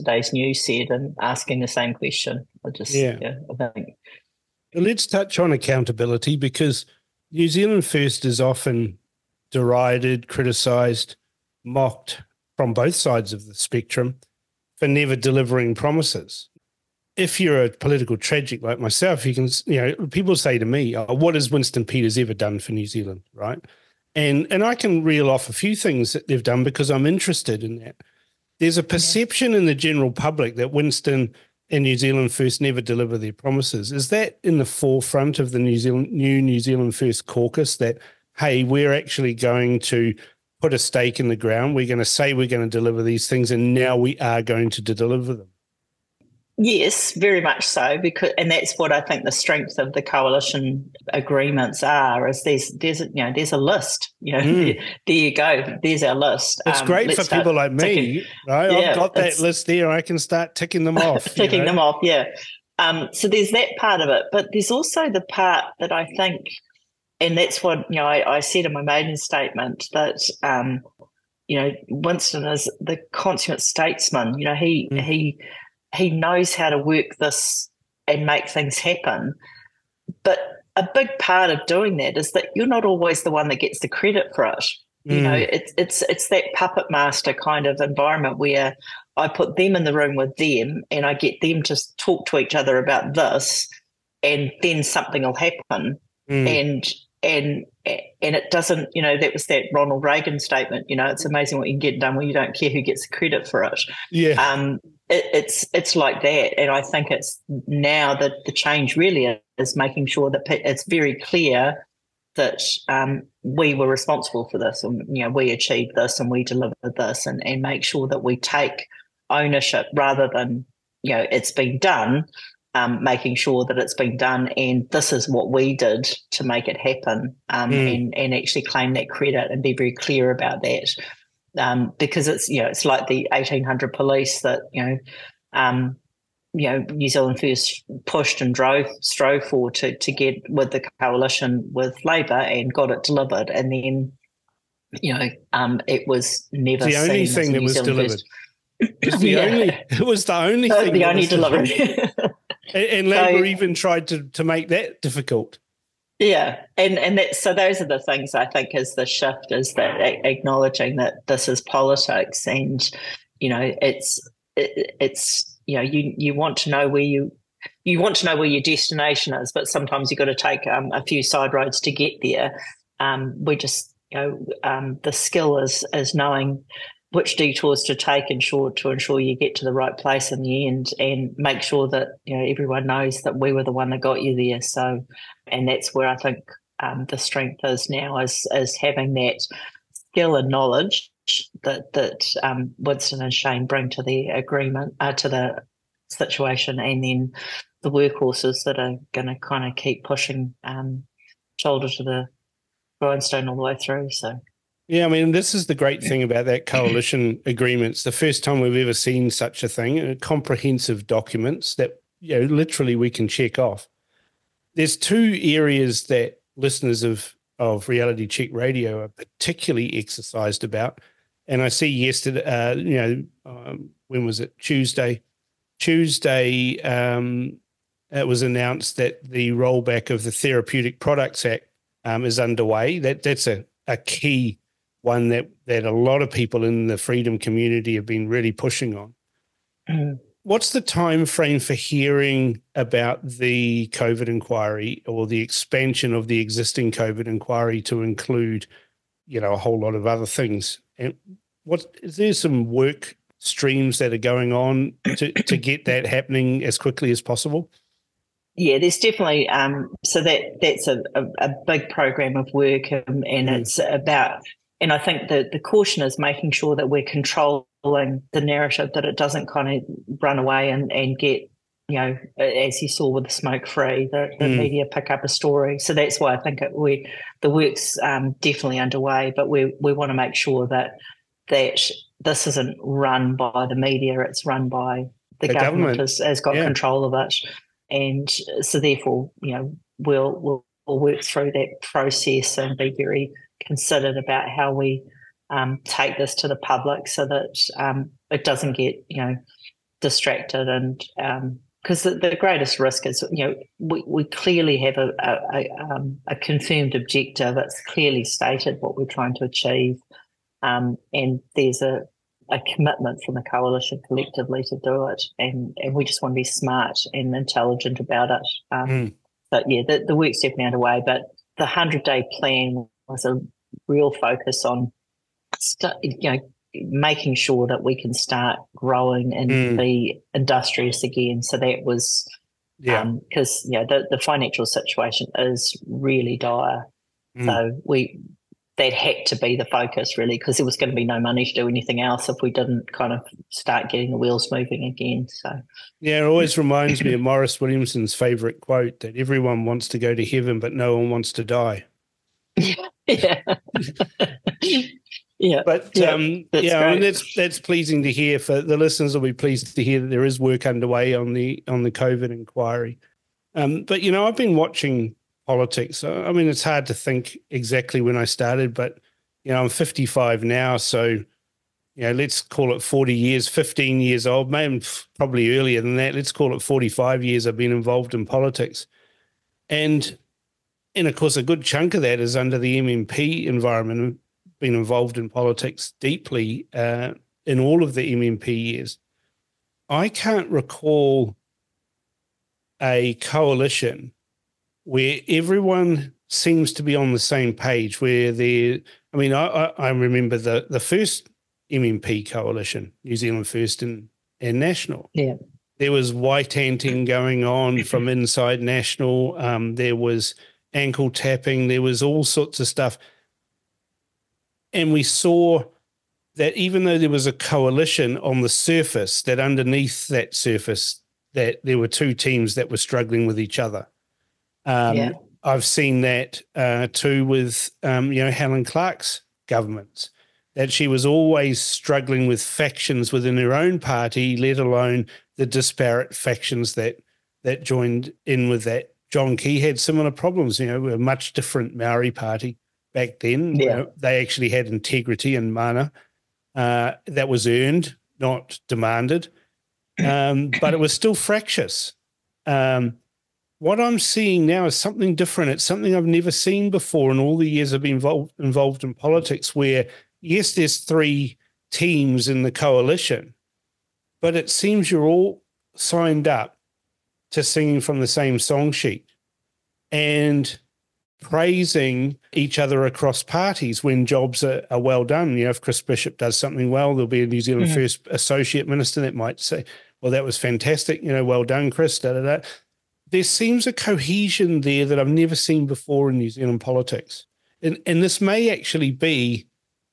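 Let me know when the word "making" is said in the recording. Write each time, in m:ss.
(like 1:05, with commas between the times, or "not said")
1:49, 2:03, 4:26, 5:26.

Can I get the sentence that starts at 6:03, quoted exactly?
Um, but you know, I've been watching politics.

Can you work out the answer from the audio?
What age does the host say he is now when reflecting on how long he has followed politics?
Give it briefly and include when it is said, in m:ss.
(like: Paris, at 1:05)
55, at 6:09.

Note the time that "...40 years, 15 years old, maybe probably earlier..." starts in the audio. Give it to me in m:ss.
6:12.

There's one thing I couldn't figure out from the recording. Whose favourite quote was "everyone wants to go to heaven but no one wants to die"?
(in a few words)
Maurice Williamson.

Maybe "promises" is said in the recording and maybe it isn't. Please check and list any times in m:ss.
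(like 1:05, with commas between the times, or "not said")
0:15, 0:33.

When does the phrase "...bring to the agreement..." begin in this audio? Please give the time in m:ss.
3:13.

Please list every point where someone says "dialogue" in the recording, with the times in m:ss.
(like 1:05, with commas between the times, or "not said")
not said.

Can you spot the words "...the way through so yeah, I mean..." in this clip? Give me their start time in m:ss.
3:23.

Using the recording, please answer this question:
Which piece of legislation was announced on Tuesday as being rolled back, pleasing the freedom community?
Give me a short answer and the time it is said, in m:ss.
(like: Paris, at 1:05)
Therapeutic Products Act, at 3:50.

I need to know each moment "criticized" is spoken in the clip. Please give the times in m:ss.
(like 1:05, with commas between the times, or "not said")
0:10.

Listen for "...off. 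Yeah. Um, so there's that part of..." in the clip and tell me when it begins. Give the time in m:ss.
1:01.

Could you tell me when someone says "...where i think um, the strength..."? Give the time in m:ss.
3:05.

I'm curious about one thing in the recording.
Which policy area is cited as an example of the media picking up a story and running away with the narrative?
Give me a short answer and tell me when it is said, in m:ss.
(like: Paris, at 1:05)
smoke free, at 4:33.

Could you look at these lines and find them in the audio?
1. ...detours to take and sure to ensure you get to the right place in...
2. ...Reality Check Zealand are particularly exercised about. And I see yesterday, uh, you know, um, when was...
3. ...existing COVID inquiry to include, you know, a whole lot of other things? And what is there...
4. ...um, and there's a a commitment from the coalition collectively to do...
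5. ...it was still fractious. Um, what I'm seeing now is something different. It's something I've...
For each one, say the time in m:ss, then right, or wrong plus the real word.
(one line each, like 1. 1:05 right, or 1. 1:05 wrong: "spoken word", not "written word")
1. 2:57 right
2. 3:37 wrong: "Radio", not "Zealand"
3. 4:06 right
4. 5:10 right
5. 7:30 right.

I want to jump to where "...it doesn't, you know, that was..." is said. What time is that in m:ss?
1:38.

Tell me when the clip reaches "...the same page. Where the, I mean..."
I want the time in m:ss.
6:37.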